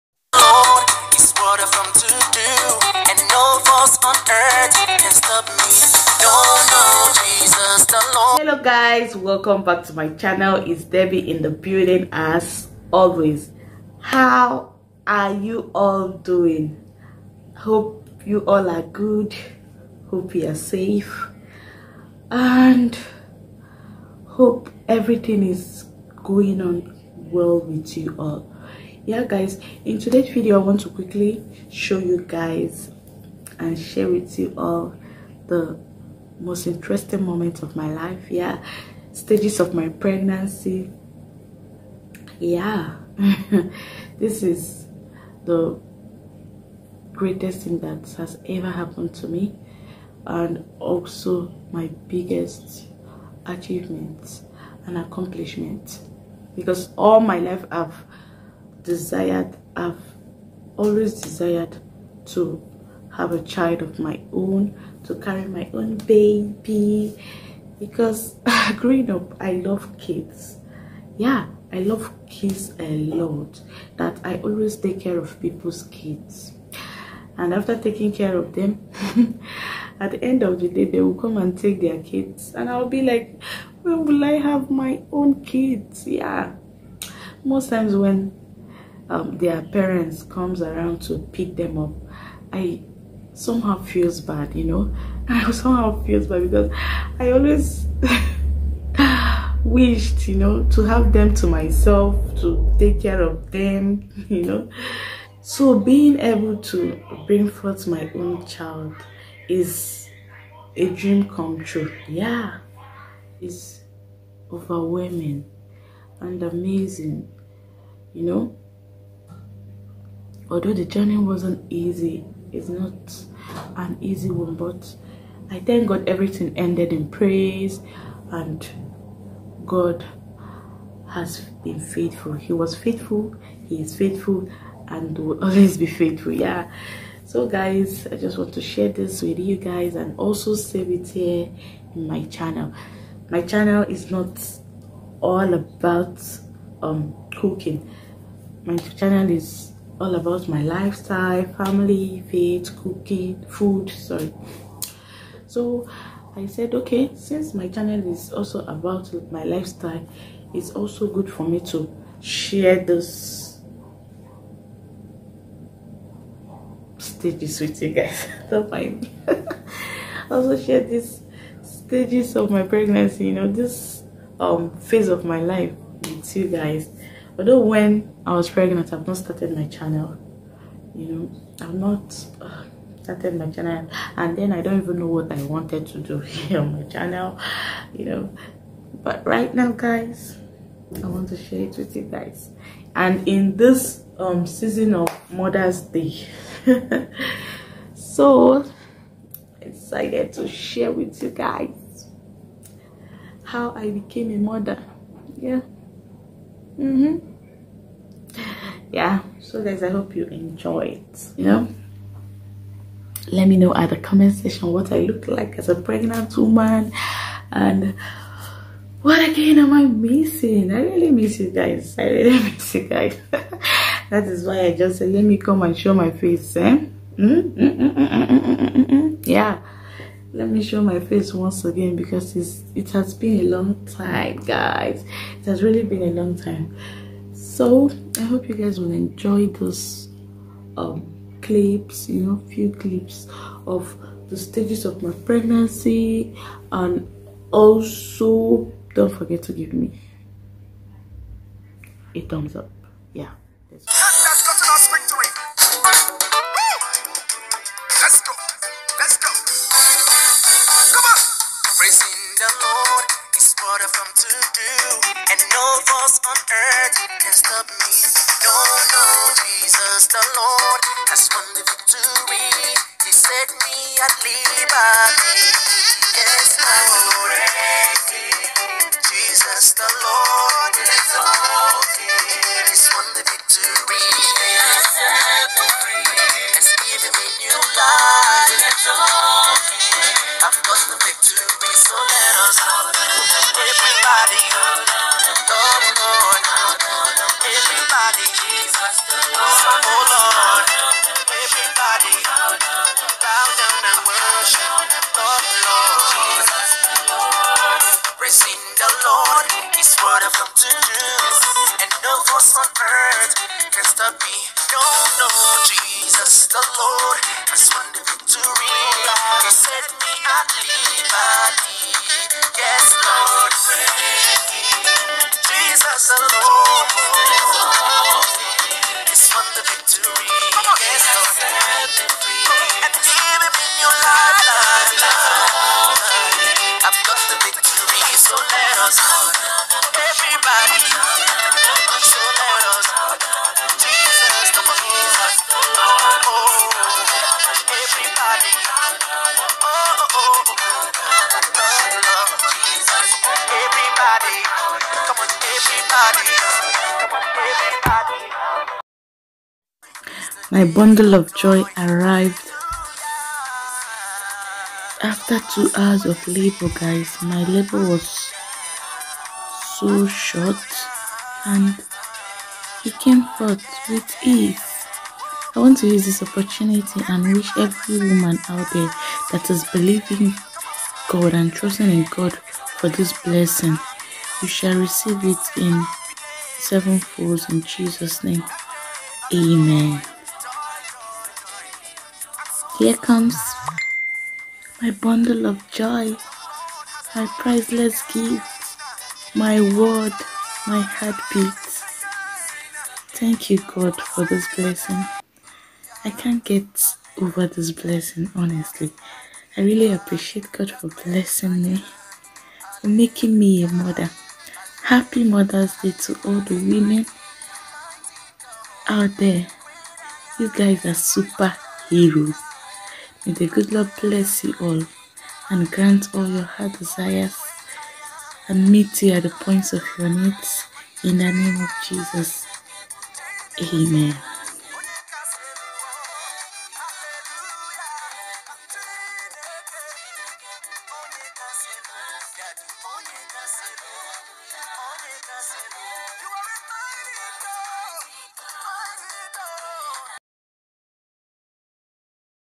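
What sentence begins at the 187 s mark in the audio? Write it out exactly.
You know, but right now, guys, I want to share it with you guys.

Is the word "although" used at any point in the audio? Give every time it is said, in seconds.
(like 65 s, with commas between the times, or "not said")
120 s, 177 s.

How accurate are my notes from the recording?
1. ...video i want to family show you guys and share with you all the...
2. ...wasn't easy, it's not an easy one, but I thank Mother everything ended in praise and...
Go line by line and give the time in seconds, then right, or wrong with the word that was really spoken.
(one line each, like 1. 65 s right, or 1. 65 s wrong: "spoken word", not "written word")
1. 30 s wrong: "quickly", not "family"
2. 121 s wrong: "God", not "Mother".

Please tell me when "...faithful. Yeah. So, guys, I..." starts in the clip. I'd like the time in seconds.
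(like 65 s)
135 s.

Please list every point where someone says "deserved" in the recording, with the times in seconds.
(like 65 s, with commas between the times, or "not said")
not said.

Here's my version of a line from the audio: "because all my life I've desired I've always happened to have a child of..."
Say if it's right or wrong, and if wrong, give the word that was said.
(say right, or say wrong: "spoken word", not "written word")
wrong: "desired", not "happened".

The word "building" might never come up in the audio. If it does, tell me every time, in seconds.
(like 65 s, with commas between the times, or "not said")
11 s.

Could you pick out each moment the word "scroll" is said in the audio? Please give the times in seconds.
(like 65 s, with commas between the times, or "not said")
not said.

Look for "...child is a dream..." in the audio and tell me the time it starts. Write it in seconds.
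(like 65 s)
108 s.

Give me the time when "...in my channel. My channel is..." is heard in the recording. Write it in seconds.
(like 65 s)
141 s.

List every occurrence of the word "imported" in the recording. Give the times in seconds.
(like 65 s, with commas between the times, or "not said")
not said.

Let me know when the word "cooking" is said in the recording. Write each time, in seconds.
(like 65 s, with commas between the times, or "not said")
147 s, 152 s.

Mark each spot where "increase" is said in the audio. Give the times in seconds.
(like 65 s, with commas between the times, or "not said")
not said.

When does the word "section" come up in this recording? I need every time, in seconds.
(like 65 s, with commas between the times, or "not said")
214 s.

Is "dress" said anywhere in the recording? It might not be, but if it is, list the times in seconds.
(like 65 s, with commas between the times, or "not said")
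not said.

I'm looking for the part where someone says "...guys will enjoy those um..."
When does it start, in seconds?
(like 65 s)
238 s.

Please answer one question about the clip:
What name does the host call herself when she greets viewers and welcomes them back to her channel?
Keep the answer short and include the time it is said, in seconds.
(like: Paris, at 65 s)
Debby, at 10 s.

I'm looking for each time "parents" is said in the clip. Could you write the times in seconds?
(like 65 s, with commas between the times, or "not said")
89 s.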